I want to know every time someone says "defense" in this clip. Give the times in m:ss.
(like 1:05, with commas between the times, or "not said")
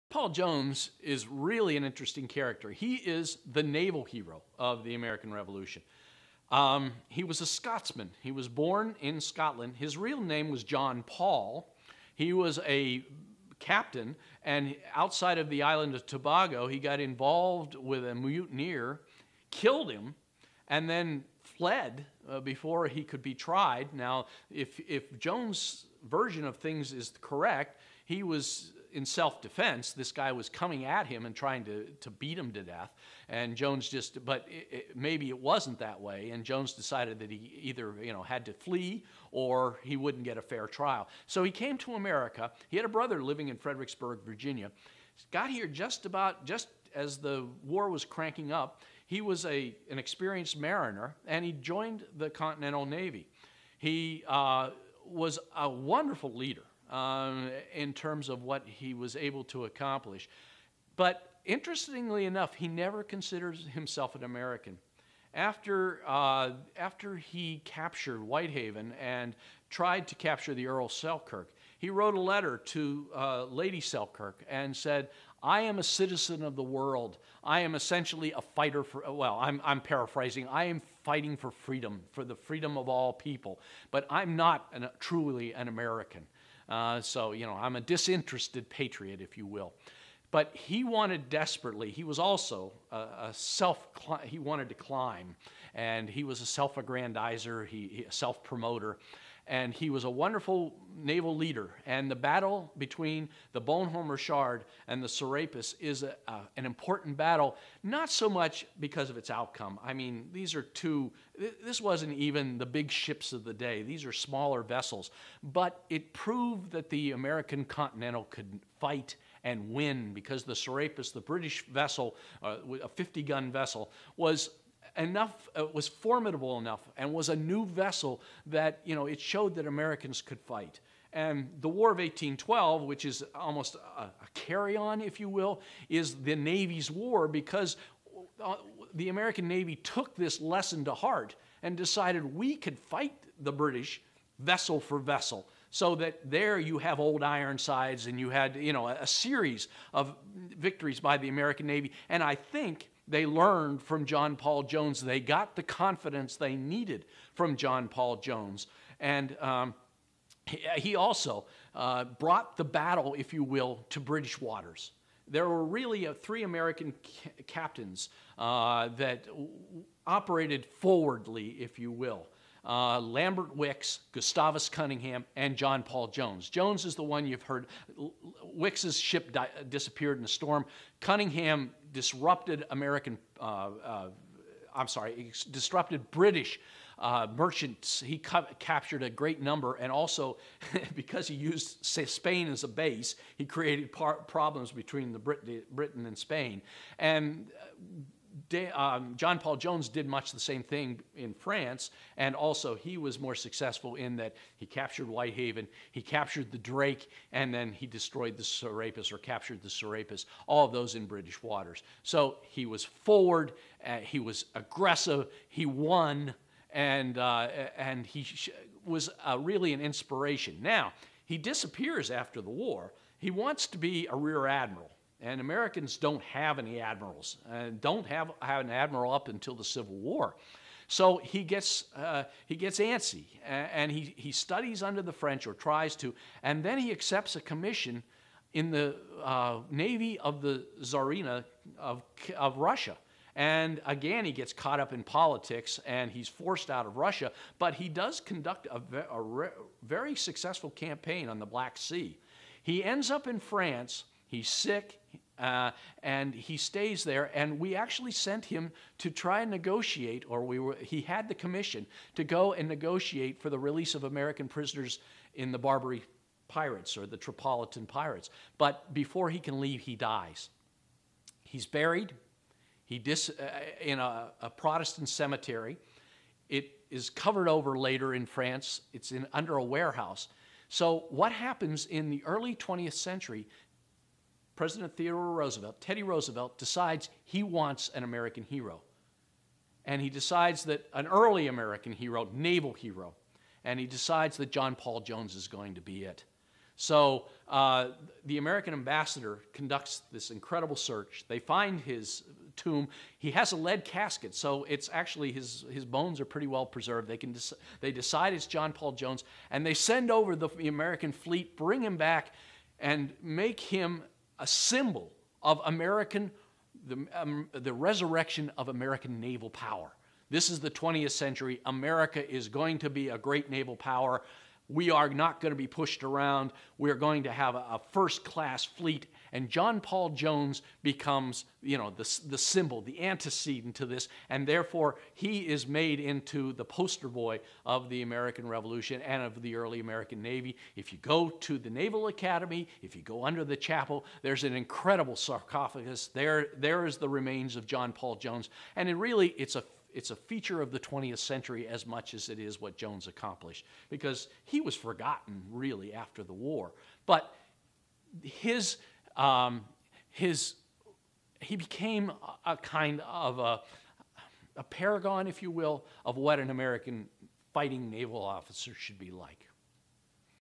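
0:29.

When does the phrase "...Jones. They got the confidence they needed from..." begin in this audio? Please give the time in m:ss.
2:34.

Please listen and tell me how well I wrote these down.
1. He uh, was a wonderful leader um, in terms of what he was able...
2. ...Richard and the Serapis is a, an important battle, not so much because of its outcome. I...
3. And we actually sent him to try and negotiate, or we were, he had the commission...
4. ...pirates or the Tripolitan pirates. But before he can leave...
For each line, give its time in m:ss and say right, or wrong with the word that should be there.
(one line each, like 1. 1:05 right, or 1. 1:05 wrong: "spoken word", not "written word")
1. 0:53 right
2. 1:44 right
3. 4:17 right
4. 4:26 right.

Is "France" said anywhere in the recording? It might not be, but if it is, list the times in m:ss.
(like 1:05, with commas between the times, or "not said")
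3:21, 4:13, 4:38.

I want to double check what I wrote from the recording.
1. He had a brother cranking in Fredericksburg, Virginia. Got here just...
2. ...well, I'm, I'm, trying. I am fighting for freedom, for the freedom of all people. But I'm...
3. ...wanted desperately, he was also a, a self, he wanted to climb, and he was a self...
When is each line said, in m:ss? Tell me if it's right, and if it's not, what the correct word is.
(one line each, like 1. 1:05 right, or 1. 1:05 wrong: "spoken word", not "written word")
1. 0:42 wrong: "living", not "cranking"
2. 1:19 wrong: "paraphrasing", not "trying"
3. 1:30 right.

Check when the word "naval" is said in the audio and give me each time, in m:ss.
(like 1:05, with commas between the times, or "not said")
0:03, 1:40, 4:52, 5:19, 5:23, 5:41, 6:07.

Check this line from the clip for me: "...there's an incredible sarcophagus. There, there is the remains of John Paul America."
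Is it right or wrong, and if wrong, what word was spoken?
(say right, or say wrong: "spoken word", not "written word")
wrong: "Jones", not "America".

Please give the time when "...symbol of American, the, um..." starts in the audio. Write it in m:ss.
5:14.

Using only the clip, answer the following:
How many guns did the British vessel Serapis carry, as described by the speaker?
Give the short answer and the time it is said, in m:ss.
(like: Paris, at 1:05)
50, at 2:02.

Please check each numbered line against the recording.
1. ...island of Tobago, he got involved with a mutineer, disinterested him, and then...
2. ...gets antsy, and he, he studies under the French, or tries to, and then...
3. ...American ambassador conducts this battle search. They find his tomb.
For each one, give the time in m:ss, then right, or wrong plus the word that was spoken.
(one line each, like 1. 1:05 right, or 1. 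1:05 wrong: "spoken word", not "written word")
1. 0:15 wrong: "killed", not "disinterested"
2. 3:52 right
3. 4:58 wrong: "incredible", not "battle".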